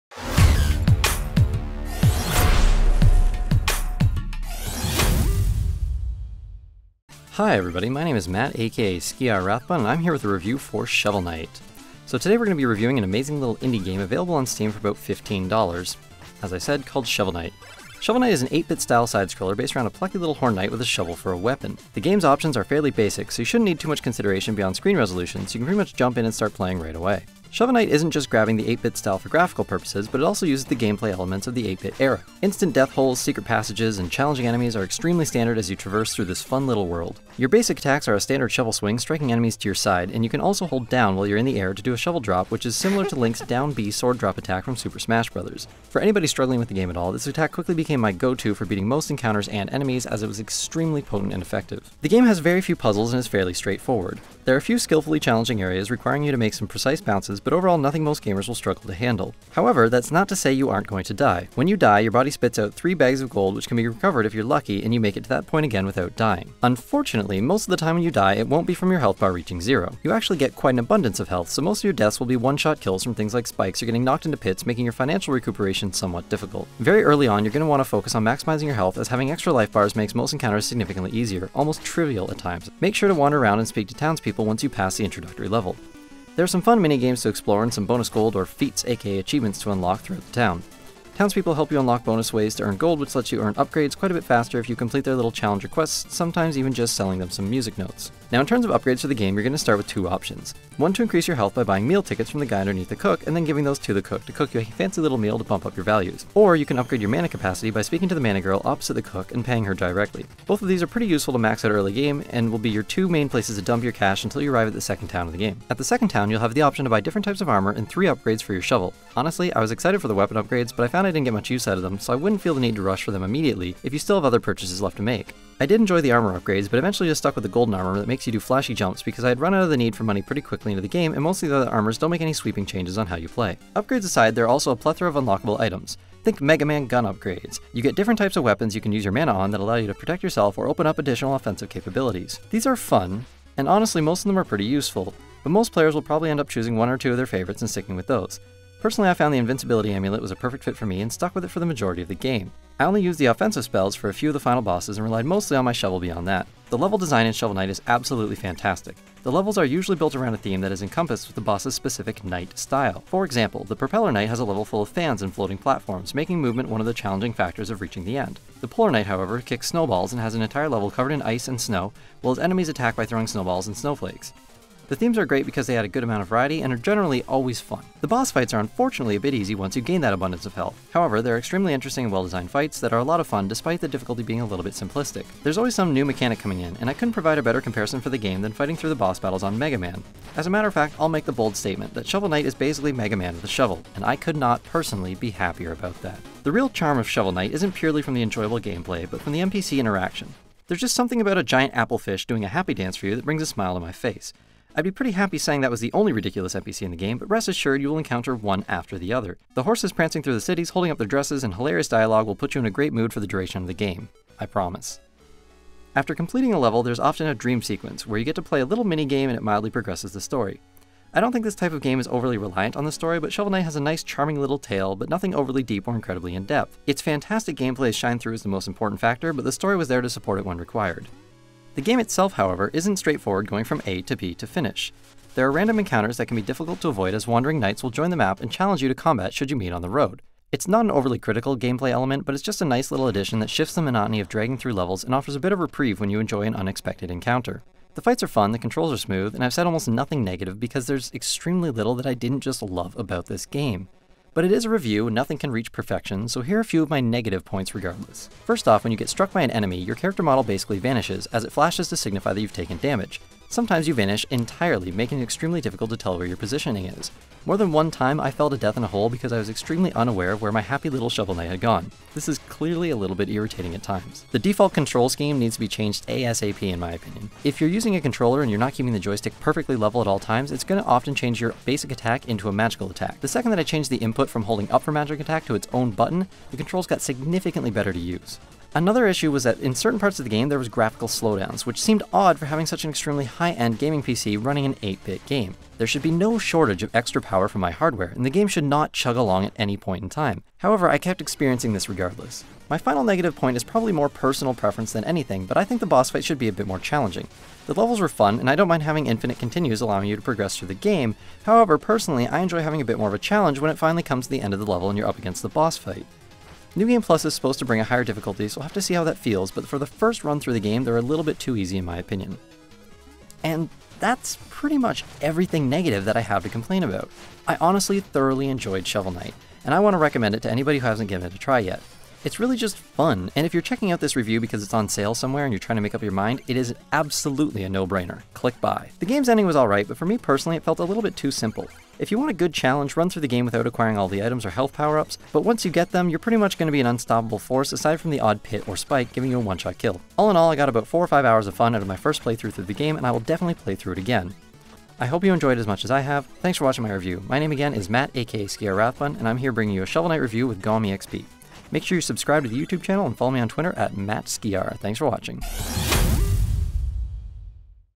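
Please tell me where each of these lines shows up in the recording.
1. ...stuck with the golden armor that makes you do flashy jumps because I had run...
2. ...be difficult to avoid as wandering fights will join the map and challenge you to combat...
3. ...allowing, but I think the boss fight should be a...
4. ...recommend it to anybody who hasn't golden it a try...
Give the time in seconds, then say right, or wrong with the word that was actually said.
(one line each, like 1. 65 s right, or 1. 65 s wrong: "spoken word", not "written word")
1. 127 s right
2. 236 s wrong: "knights", not "fights"
3. 305 s wrong: "anything", not "allowing"
4. 329 s wrong: "given", not "golden".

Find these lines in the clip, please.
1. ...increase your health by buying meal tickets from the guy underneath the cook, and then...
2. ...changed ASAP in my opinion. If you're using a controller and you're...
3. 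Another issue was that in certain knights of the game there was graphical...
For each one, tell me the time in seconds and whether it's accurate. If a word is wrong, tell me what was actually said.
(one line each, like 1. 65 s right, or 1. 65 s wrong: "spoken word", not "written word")
1. 101 s right
2. 275 s right
3. 288 s wrong: "parts", not "knights".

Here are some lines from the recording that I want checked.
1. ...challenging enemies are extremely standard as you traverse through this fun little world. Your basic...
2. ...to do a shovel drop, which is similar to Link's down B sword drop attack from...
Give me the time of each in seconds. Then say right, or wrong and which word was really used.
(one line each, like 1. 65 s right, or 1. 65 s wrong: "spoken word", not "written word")
1. 34 s right
2. 41 s right.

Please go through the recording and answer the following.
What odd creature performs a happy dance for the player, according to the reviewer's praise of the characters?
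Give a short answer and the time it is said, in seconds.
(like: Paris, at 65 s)
applefish, at 201 s.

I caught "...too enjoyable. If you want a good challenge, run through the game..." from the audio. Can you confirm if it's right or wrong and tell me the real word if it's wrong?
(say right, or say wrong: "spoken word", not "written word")
wrong: "simple", not "enjoyable".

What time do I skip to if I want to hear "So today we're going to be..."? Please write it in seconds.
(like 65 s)
12 s.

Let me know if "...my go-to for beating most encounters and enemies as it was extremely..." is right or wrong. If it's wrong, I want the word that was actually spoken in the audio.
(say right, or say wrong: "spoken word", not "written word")
right.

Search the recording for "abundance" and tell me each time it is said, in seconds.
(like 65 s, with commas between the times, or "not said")
70 s, 180 s.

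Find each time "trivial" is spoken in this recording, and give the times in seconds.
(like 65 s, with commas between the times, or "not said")
81 s.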